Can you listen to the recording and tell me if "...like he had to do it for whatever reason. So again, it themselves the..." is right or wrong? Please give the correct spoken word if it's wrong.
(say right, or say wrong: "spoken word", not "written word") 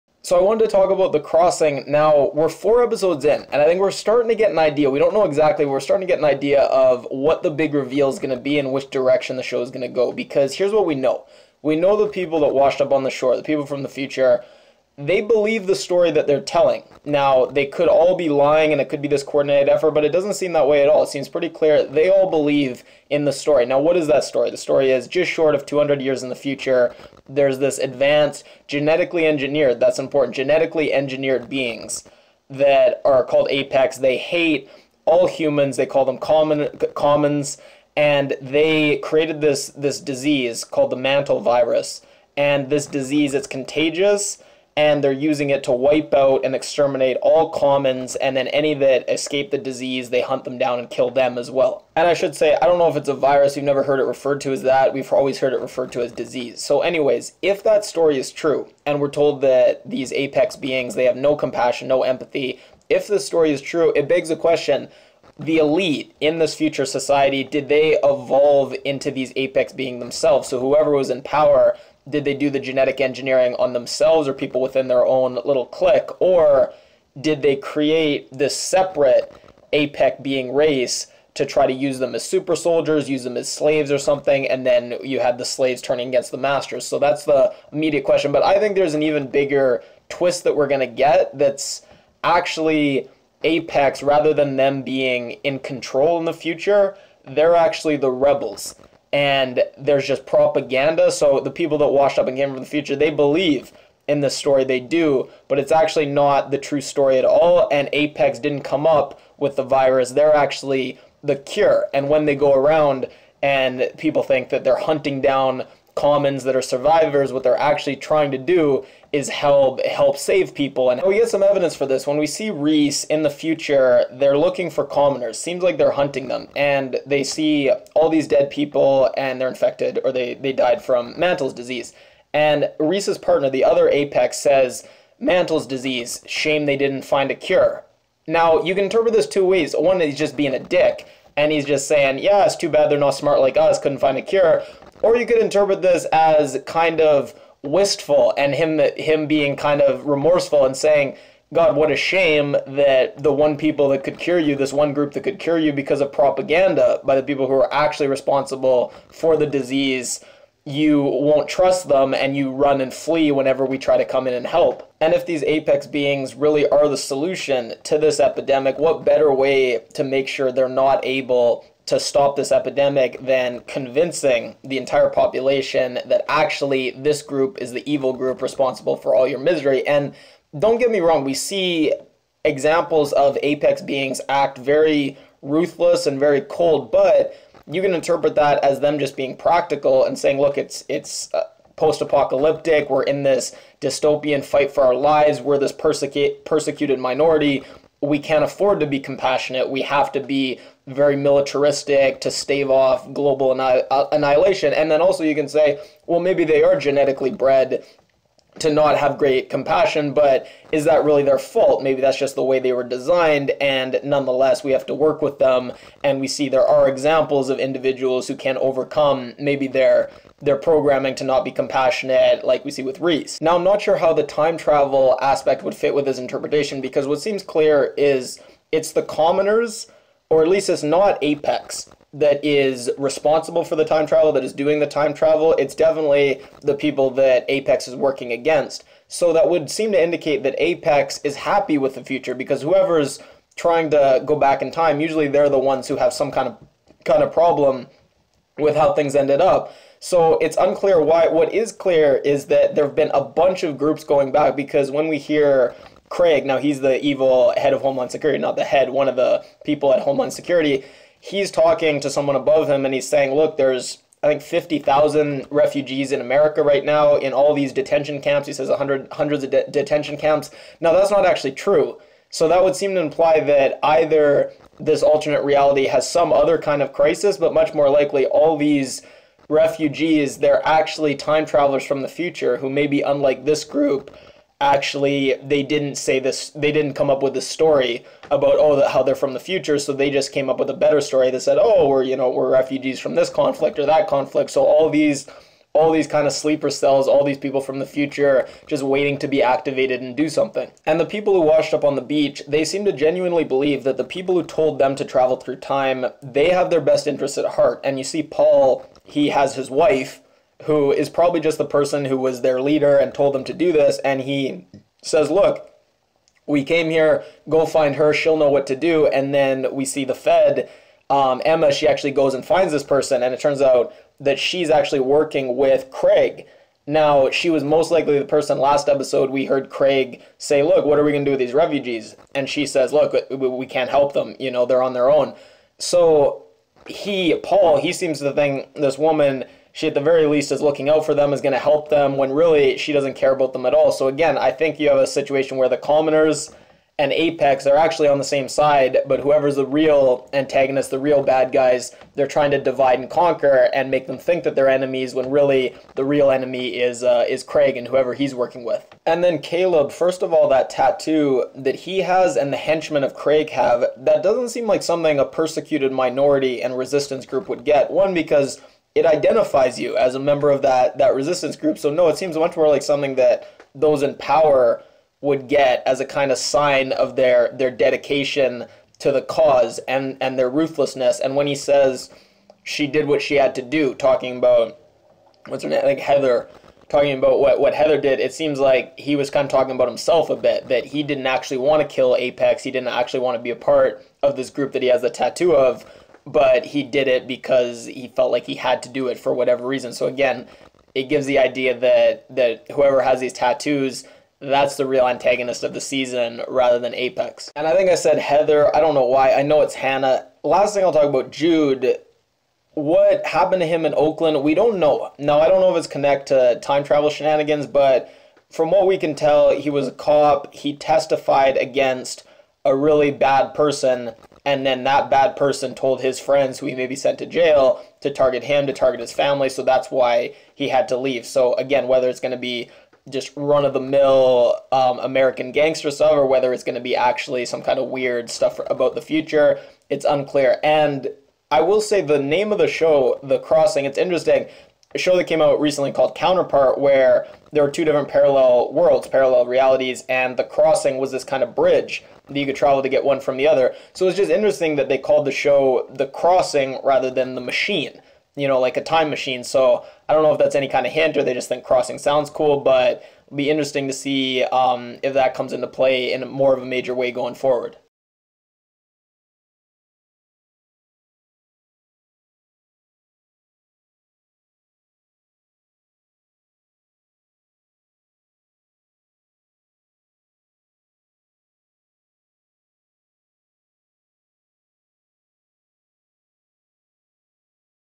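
wrong: "gives", not "themselves".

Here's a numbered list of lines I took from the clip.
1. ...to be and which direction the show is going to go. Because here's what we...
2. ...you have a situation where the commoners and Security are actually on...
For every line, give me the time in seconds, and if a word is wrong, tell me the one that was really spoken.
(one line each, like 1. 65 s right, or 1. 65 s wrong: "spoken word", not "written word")
1. 8 s right
2. 344 s wrong: "Apex", not "Security".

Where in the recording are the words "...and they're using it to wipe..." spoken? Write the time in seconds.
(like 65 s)
44 s.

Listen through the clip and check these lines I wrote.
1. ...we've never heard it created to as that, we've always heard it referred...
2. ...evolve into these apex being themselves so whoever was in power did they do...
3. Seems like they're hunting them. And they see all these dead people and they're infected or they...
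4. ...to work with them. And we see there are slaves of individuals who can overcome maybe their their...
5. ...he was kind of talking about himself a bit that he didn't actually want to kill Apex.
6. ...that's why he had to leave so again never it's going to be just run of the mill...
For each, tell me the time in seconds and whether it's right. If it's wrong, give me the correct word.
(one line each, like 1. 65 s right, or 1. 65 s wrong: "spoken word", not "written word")
1. 53 s wrong: "referred", not "created"
2. 68 s right
3. 125 s right
4. 214 s wrong: "examples", not "slaves"
5. 388 s right
6. 429 s wrong: "whether", not "never".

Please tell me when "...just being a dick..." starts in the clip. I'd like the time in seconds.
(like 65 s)
140 s.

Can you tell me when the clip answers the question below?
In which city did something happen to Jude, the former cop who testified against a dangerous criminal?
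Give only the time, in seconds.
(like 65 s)
413 s.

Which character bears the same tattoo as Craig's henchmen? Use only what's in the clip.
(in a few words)
Caleb.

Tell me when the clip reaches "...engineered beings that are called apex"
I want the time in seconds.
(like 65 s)
30 s.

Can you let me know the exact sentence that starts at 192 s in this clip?
We're in this dystopian fight for our lives.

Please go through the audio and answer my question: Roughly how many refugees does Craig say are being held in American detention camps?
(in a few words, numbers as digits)
50,000.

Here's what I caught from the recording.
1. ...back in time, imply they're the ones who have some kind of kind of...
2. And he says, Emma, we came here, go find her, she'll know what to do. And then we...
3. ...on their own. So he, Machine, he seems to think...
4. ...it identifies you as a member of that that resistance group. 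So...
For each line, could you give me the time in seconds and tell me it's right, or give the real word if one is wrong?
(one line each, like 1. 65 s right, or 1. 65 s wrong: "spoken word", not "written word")
1. 244 s wrong: "usually", not "imply"
2. 313 s wrong: "Look", not "Emma"
3. 334 s wrong: "Paul", not "Machine"
4. 368 s right.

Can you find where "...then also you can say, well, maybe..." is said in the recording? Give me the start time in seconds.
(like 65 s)
204 s.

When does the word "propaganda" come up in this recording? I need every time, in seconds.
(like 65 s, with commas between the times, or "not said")
100 s, 156 s.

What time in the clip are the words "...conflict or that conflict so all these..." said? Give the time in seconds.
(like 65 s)
293 s.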